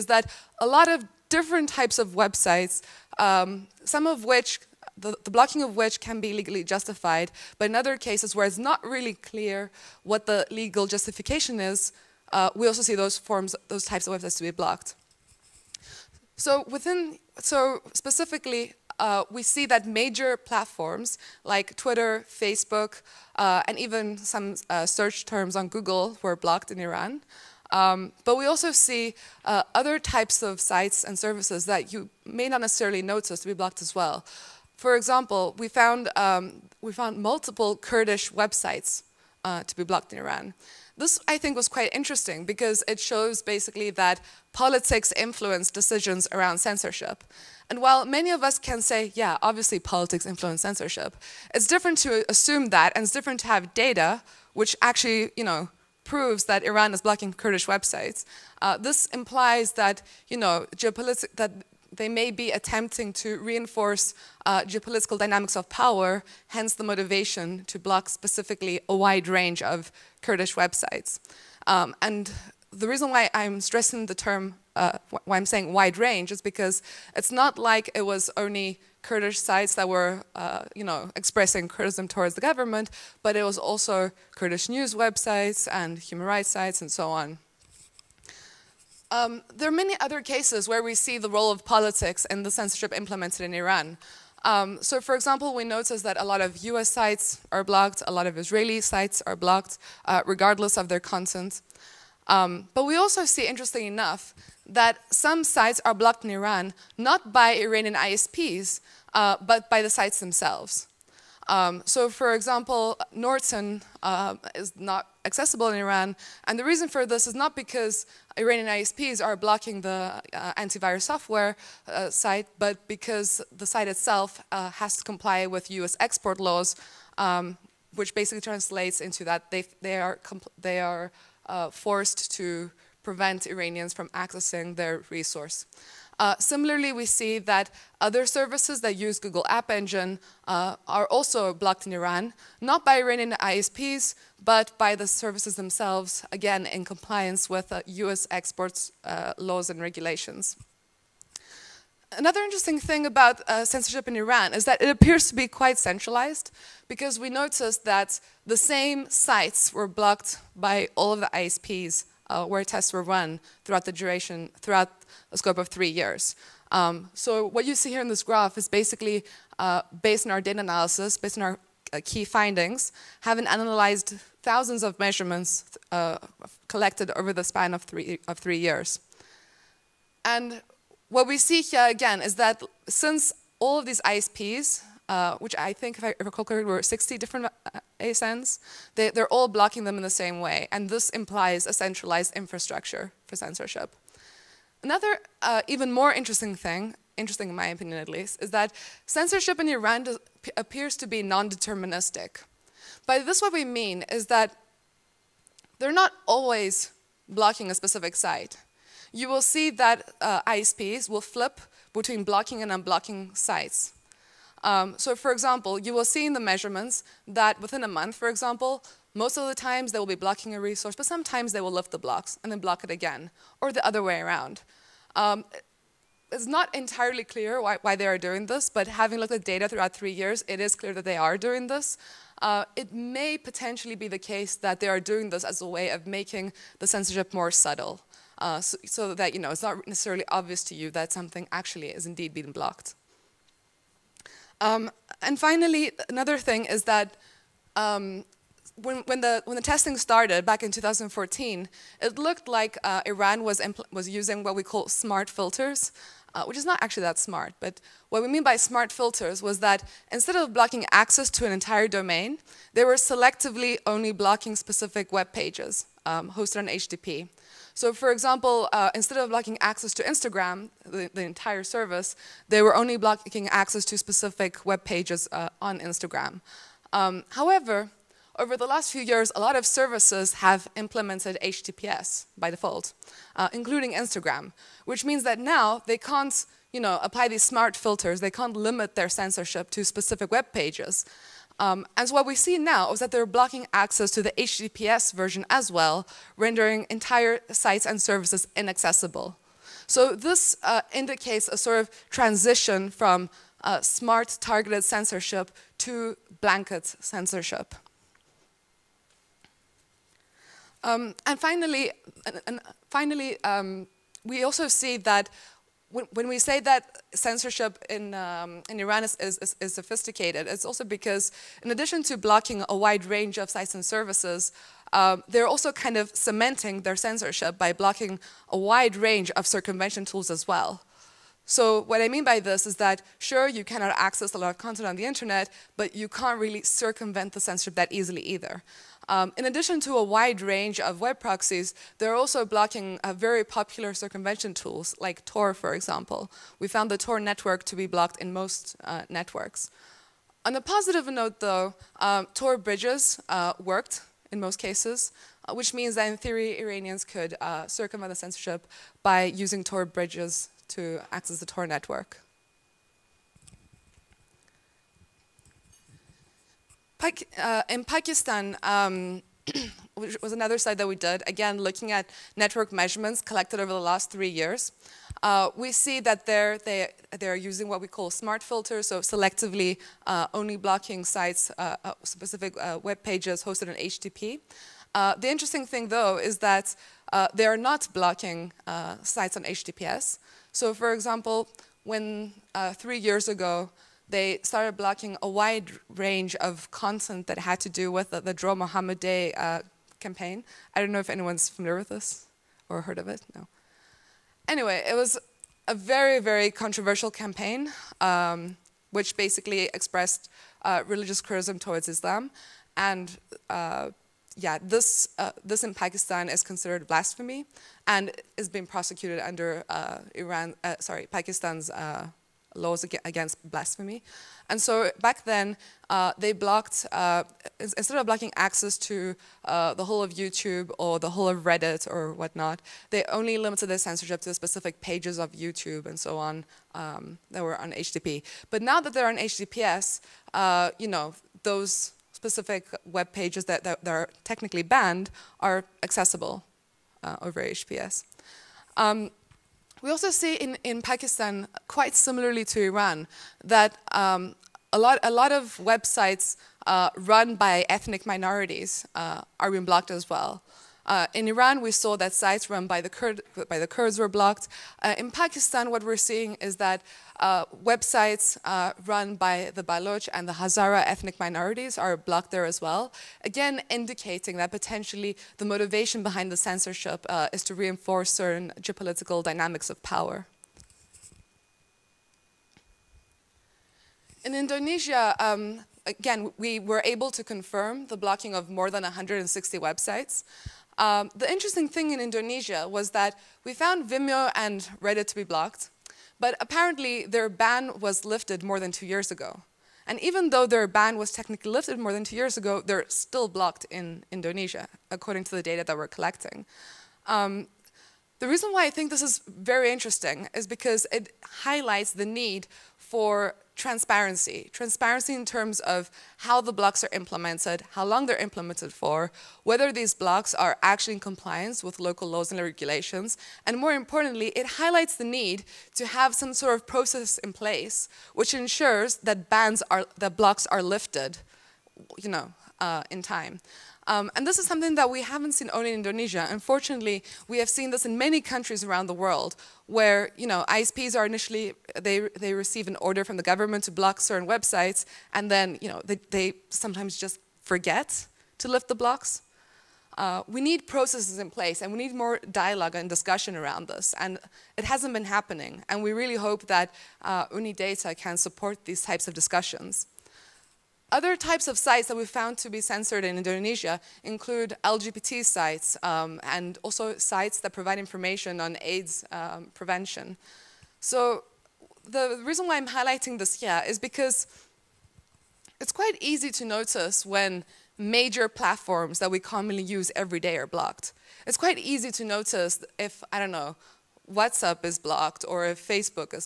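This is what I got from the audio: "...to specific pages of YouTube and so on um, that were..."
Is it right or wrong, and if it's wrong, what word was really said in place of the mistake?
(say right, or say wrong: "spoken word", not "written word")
right.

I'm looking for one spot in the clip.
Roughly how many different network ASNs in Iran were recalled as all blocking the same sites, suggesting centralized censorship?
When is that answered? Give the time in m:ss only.
3:06.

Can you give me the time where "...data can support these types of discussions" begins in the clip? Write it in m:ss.
9:17.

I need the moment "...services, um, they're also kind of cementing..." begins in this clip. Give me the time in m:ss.
5:23.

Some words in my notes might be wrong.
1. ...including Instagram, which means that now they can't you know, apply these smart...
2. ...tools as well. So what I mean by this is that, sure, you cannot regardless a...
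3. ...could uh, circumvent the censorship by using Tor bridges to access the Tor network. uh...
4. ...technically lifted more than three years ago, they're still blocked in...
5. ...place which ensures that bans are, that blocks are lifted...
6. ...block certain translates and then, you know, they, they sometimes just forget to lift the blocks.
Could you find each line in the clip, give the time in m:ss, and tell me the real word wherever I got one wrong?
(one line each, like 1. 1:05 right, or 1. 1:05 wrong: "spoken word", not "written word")
1. 4:43 right
2. 5:30 wrong: "access", not "regardless"
3. 5:57 right
4. 8:21 wrong: "two", not "three"
5. 8:47 right
6. 9:03 wrong: "websites", not "translates".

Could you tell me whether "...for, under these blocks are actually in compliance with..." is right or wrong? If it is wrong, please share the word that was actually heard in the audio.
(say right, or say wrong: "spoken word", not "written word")
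wrong: "whether", not "under".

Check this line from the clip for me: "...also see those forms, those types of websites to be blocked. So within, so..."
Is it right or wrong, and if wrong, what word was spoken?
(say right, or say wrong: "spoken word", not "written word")
right.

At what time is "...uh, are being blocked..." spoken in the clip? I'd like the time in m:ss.
7:38.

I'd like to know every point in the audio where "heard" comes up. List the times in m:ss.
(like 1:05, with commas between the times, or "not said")
6:42.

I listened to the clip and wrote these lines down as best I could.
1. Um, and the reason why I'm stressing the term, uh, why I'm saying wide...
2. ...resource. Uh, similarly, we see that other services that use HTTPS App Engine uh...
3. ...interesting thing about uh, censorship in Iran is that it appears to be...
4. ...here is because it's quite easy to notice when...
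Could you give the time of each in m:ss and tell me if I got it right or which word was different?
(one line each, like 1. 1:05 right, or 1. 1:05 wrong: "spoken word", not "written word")
1. 1:11 right
2. 2:15 wrong: "Google", not "HTTPS"
3. 2:32 right
4. 9:33 right.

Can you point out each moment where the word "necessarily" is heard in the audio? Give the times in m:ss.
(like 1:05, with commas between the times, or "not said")
0:32, 3:59.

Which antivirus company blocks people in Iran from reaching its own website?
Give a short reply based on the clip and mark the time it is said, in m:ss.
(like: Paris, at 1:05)
Norton, at 1:53.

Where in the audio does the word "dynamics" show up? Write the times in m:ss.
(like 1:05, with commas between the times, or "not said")
1:05, 7:59.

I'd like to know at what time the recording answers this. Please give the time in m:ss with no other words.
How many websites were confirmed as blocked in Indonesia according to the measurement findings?
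8:08.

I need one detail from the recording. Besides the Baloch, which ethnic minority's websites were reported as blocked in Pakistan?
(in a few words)
Hazara.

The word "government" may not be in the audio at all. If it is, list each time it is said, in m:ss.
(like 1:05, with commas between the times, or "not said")
1:22, 9:03.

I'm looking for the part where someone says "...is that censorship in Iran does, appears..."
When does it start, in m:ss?
3:18.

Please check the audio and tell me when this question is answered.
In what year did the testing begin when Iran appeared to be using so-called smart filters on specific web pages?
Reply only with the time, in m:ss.
4:10.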